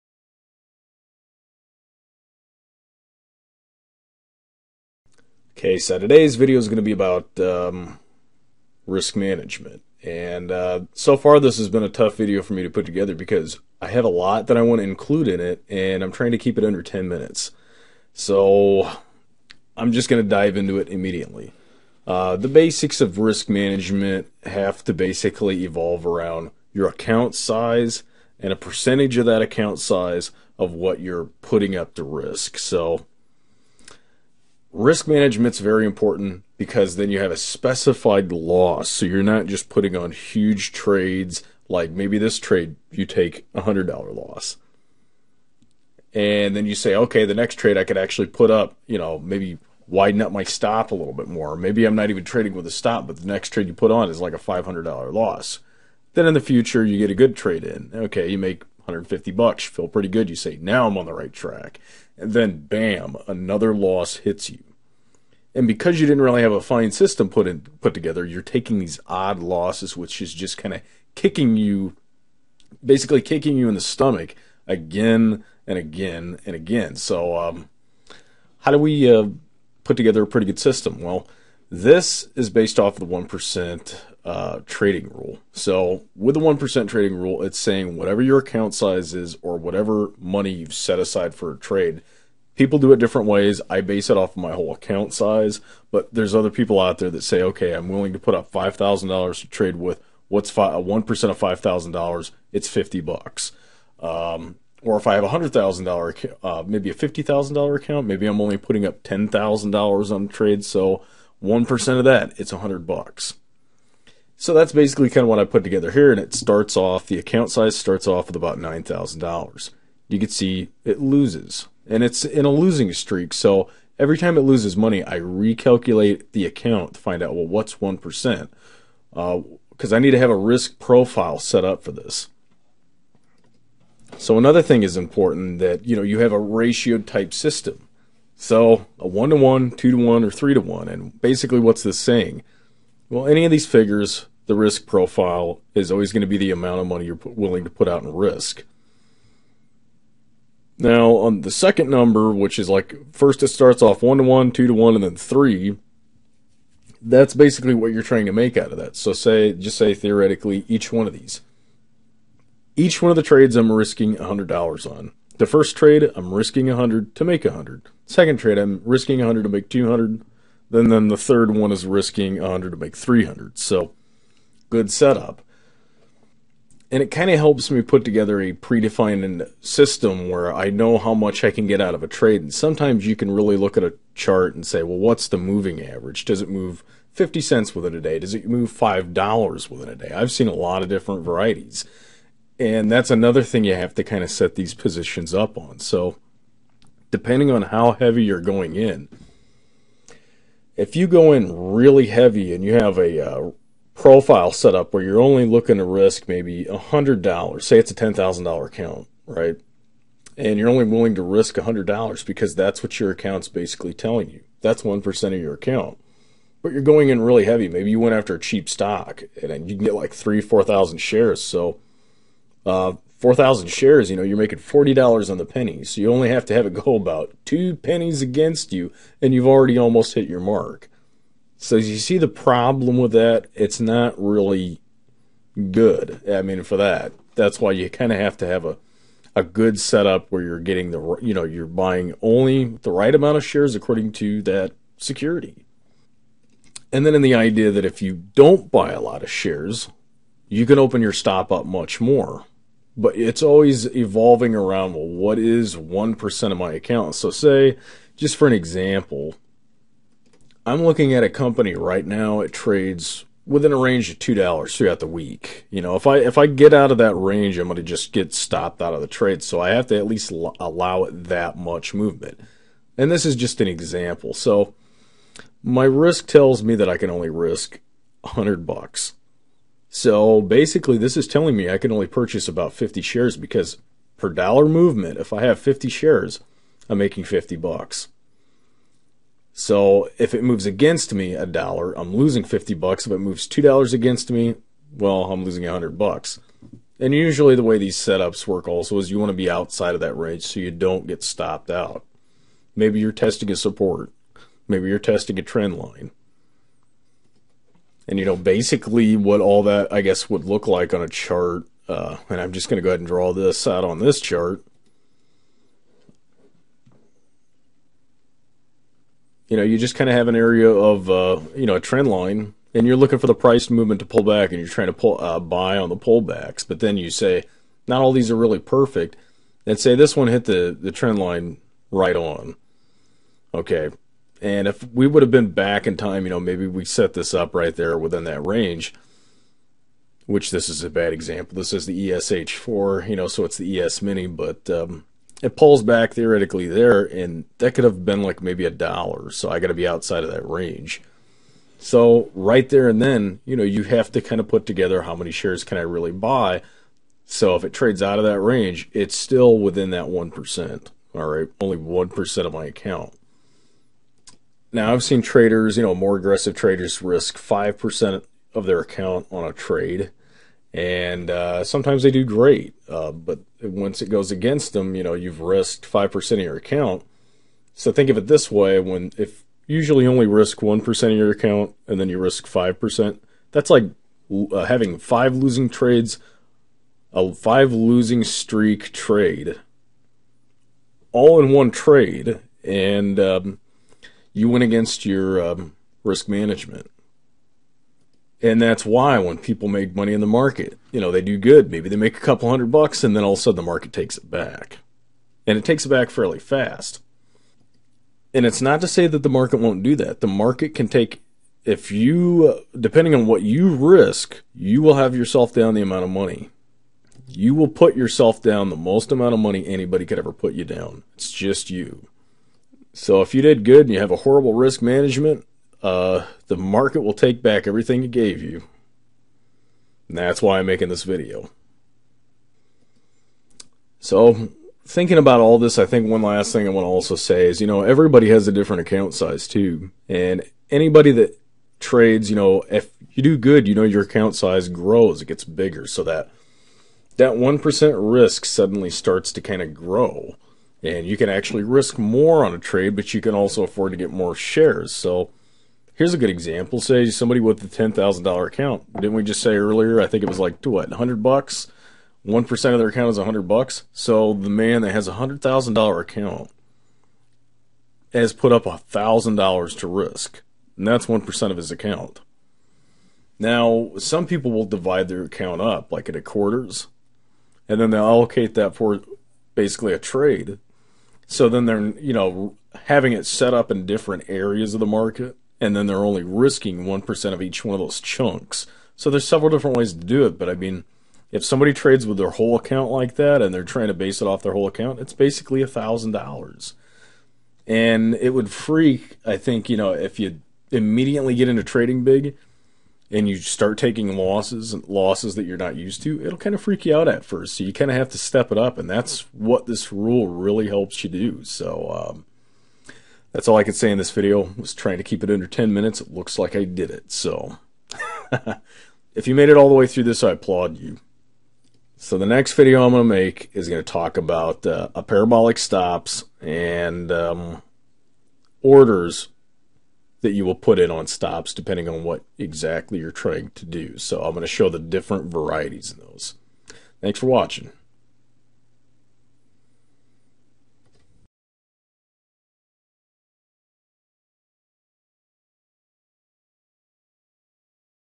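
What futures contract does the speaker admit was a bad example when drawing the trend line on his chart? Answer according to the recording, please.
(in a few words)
ESH4.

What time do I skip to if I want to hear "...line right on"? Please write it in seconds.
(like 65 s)
331 s.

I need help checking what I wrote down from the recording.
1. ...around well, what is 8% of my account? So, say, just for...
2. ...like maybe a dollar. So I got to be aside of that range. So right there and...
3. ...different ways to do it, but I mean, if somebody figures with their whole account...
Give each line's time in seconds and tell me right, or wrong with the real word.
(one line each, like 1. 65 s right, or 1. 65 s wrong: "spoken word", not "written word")
1. 254 s wrong: "1", not "8"
2. 348 s wrong: "outside", not "aside"
3. 489 s wrong: "trades", not "figures".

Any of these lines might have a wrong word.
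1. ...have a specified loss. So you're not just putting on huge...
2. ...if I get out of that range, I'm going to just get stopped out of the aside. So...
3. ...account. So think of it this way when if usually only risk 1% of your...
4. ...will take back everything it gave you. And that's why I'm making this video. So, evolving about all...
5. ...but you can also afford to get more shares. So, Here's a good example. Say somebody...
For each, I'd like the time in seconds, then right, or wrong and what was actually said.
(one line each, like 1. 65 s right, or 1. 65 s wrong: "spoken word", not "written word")
1. 37 s right
2. 266 s wrong: "trade", not "aside"
3. 376 s right
4. 427 s wrong: "thinking", not "evolving"
5. 452 s right.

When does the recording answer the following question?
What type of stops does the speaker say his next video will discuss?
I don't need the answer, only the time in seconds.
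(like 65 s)
525 s.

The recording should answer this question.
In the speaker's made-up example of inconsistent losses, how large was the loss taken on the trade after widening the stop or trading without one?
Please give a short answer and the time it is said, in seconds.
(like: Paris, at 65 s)
$500, at 54 s.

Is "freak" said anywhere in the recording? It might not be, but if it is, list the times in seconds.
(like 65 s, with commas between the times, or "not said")
498 s, 506 s.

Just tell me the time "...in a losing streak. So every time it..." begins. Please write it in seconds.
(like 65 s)
122 s.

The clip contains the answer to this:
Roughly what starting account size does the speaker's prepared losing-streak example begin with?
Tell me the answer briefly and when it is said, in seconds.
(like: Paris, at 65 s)
$9,000, at 118 s.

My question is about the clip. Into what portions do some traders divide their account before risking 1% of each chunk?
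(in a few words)
Quarters.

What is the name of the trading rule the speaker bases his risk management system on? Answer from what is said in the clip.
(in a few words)
1% trading rule.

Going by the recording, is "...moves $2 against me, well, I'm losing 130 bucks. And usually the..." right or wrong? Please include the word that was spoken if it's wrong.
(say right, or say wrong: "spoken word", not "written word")
wrong: "100", not "130".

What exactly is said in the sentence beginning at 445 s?
So that that 1% risk suddenly starts to kind of grow.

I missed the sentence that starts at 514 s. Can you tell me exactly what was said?
was trying to keep it under 10 minutes.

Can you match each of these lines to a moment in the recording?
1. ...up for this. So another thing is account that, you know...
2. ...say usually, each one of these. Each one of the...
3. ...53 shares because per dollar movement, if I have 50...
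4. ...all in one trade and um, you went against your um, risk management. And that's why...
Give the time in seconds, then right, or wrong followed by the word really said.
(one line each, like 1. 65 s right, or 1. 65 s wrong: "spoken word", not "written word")
1. 131 s wrong: "important", not "account"
2. 159 s wrong: "theoretically", not "usually"
3. 282 s wrong: "50", not "53"
4. 391 s right.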